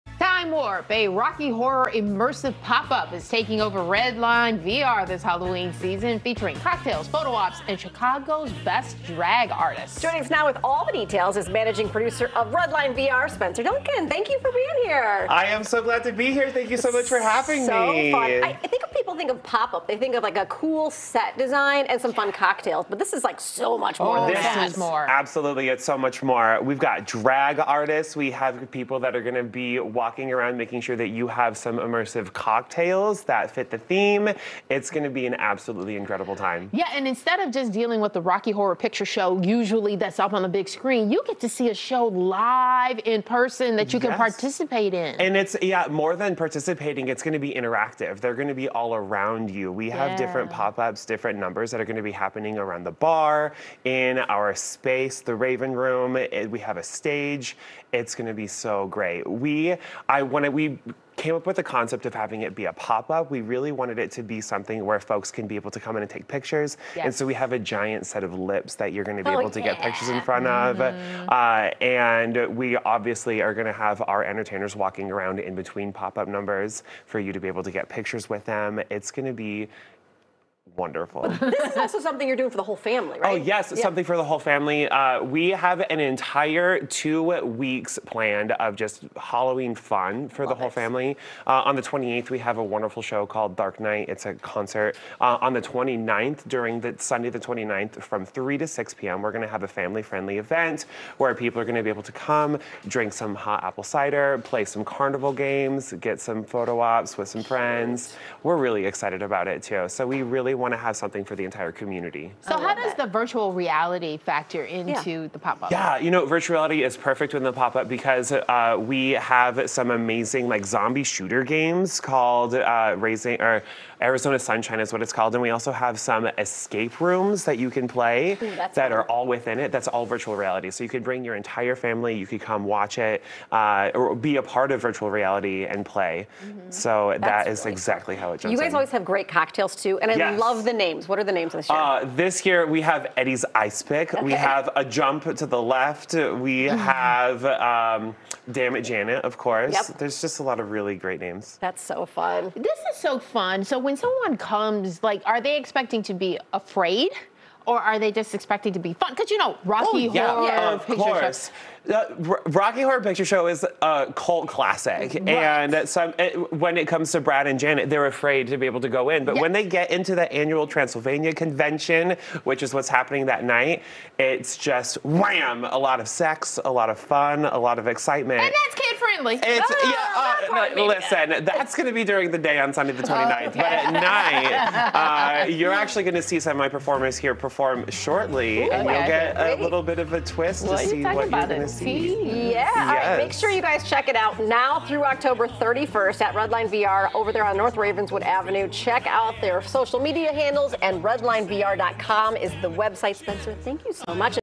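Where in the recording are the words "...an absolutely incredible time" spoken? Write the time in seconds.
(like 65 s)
35 s.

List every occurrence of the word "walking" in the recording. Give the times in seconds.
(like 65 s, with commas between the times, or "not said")
29 s, 74 s.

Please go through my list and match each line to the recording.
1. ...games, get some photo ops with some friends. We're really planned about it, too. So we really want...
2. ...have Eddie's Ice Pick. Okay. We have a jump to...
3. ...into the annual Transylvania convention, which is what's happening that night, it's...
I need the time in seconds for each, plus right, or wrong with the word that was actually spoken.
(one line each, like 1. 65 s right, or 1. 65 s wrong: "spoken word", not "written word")
1. 105 s wrong: "excited", not "planned"
2. 142 s right
3. 169 s right.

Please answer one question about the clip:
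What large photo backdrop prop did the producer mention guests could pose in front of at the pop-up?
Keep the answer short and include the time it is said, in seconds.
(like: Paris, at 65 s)
A giant set of lips, at 67 s.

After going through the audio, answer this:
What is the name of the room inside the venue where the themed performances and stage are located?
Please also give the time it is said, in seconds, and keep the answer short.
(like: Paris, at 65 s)
The Raven Room, at 55 s.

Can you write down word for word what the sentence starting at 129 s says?
That's all virtual reality, so you could bring your entire family.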